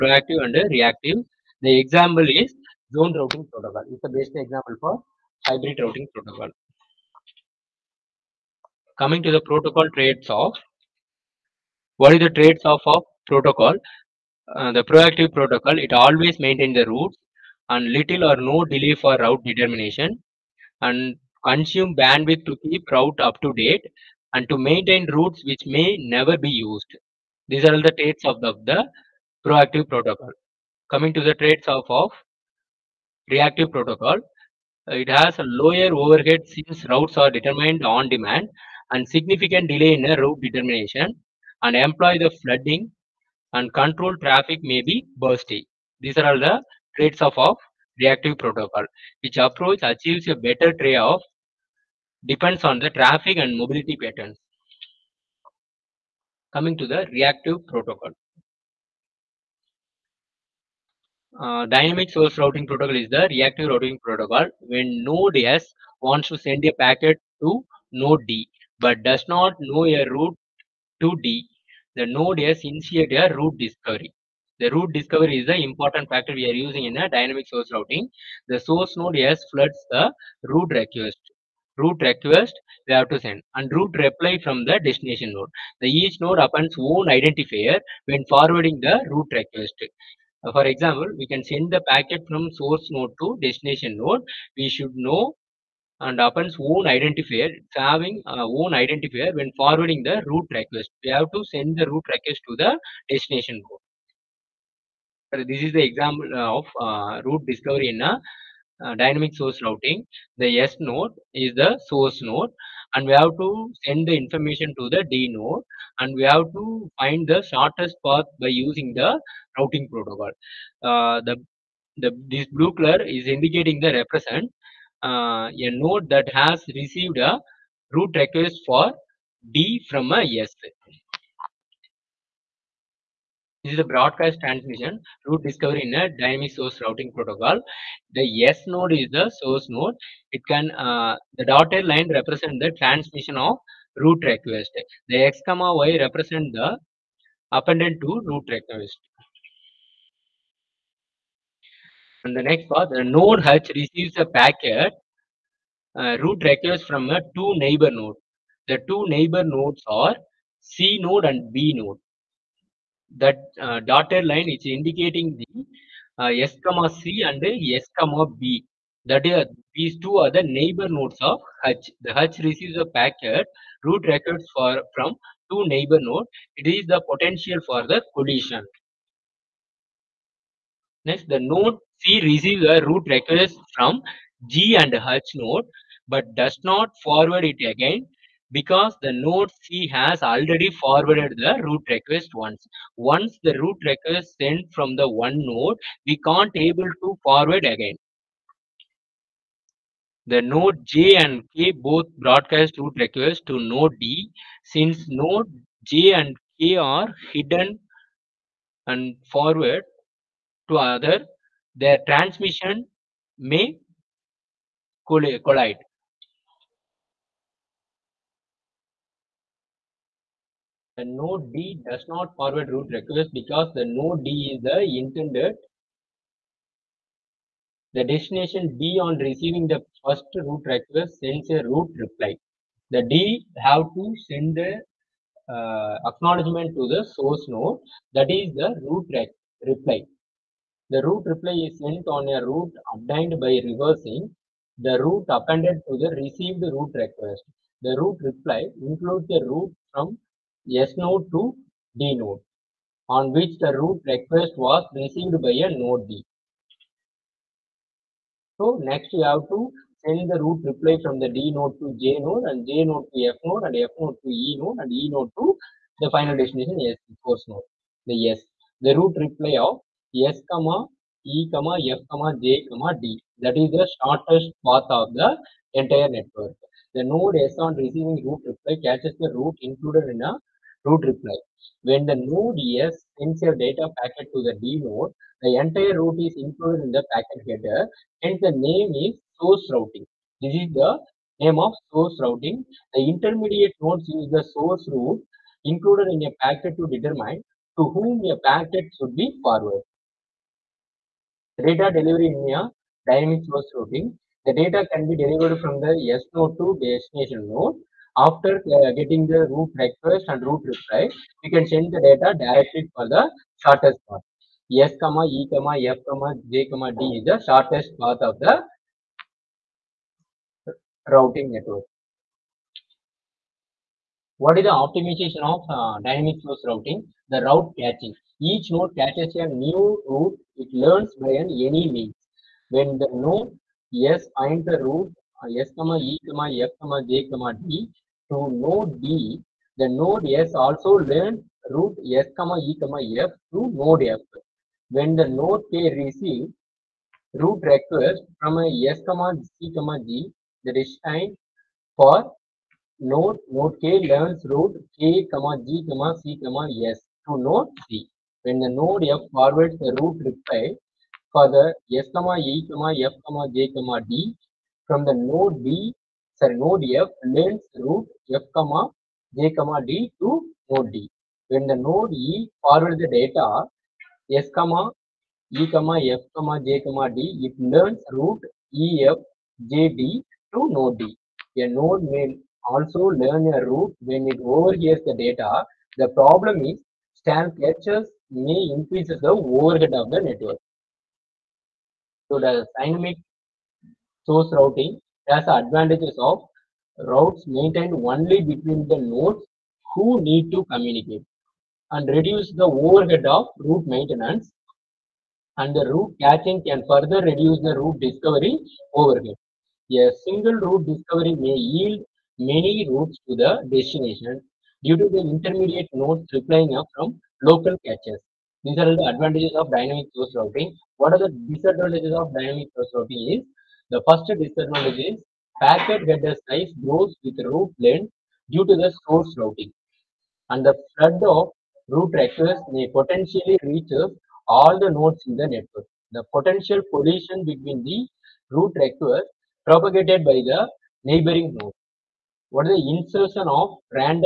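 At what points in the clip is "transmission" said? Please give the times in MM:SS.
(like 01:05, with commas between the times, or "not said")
02:14, 02:22, 03:32.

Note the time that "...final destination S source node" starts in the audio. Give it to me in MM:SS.
04:26.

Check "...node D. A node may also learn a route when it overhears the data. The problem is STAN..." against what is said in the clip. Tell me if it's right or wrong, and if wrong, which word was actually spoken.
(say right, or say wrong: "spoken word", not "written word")
right.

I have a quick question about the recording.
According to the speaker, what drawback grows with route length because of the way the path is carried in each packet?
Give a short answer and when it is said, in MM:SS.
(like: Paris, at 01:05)
Packet header size, at 07:05.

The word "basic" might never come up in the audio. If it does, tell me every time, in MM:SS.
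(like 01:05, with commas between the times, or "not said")
00:04.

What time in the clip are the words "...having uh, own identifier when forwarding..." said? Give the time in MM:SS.
01:37.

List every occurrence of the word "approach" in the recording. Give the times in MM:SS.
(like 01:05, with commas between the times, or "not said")
00:49.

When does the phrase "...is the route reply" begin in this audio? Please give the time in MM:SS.
03:58.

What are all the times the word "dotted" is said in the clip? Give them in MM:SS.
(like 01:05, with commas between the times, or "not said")
02:21, 02:43.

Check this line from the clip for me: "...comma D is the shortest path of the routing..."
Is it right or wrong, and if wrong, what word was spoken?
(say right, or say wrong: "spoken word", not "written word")
right.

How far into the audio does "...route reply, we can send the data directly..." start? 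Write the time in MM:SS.
05:10.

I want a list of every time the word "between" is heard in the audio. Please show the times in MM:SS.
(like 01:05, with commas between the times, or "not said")
06:38, 07:17.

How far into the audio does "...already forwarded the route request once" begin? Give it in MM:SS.
03:10.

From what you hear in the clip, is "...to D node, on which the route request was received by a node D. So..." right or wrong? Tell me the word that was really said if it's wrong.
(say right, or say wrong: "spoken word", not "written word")
right.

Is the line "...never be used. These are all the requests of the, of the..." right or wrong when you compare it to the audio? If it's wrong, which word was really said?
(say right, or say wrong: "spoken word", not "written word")
wrong: "traits", not "requests".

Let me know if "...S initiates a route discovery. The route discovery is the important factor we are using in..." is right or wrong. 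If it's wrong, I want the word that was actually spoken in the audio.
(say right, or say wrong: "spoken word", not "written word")
right.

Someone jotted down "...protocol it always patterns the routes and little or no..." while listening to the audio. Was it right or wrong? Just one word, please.
wrong.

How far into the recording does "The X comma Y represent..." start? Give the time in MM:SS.
02:25.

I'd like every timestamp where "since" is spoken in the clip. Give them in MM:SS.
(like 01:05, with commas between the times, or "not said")
00:36, 03:24.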